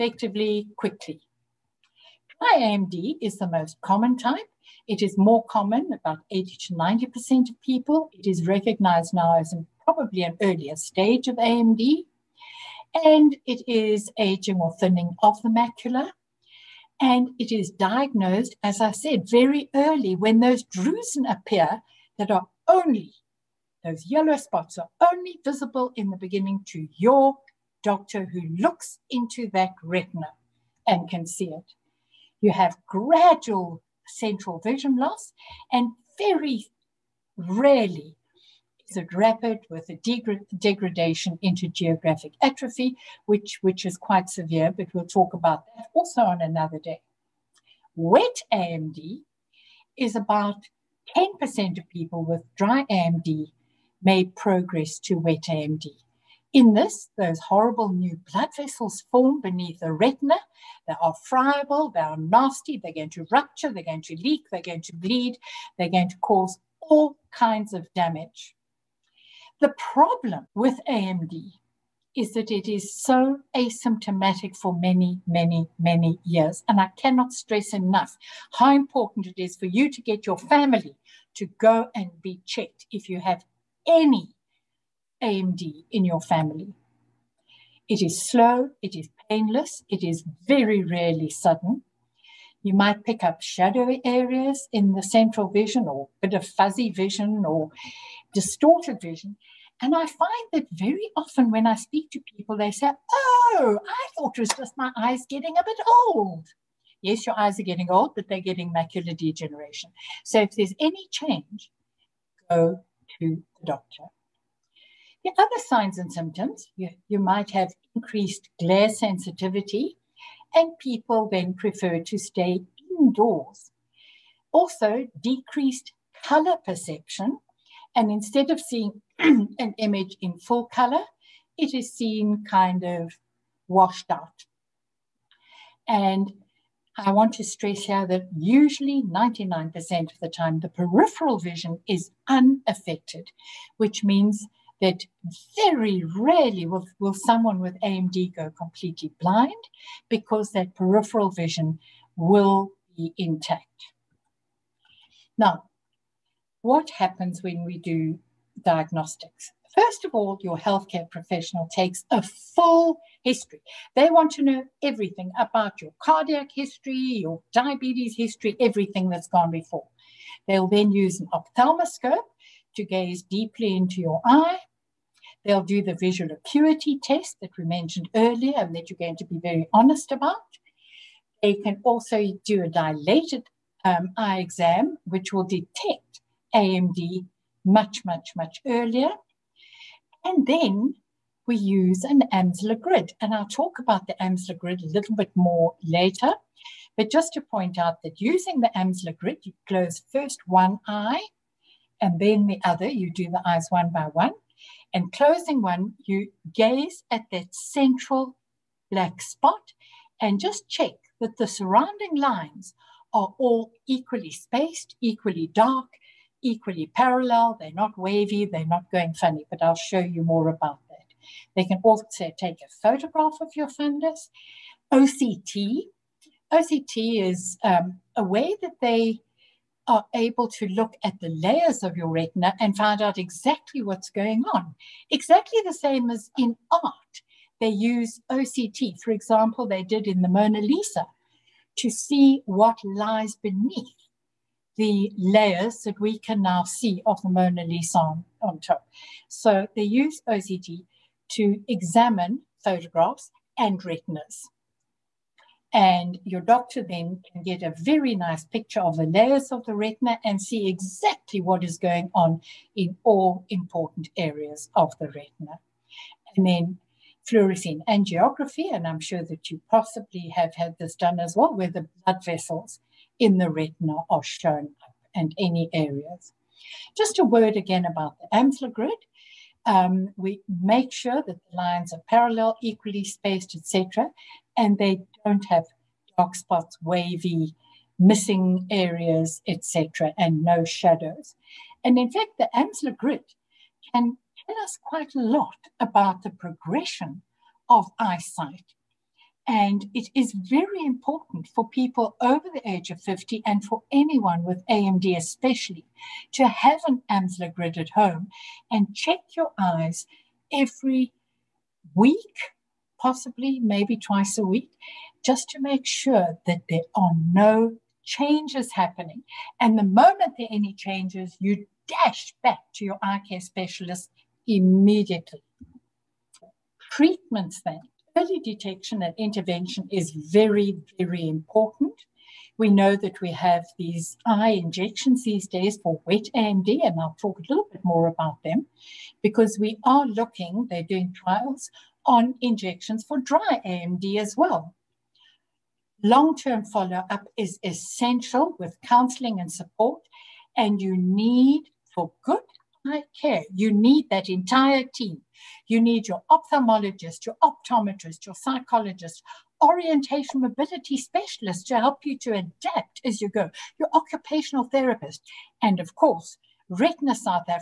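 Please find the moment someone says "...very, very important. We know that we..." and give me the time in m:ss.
5:30.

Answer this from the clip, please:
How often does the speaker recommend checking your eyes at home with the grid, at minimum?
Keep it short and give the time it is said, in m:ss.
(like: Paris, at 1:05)
Every week, at 5:10.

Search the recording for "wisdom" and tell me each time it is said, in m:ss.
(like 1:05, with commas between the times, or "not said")
not said.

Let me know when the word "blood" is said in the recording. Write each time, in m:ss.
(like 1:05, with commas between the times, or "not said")
0:58, 4:32.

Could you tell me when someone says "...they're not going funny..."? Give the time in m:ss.
3:38.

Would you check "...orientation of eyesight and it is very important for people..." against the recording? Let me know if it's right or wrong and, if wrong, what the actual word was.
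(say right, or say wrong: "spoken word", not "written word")
wrong: "progression", not "orientation".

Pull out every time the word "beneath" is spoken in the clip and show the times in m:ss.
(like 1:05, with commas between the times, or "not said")
0:59, 4:03.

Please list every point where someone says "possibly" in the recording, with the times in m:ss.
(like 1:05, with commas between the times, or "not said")
4:29, 5:13.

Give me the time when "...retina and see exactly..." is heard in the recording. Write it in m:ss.
4:19.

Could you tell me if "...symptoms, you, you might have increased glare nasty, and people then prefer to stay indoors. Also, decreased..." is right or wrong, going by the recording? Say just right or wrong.
wrong.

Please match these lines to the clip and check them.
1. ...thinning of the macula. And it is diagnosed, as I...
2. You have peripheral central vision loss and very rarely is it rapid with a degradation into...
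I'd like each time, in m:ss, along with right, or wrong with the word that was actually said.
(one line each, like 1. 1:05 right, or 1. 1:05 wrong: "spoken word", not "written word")
1. 0:14 right
2. 0:32 wrong: "gradual", not "peripheral".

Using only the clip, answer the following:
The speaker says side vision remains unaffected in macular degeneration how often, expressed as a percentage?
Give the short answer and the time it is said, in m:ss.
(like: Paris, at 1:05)
99%, at 2:19.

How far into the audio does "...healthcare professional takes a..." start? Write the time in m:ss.
2:40.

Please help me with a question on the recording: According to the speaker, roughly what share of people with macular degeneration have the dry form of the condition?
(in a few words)
80 to 90%.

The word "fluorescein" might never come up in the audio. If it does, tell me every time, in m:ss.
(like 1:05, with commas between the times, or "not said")
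4:27.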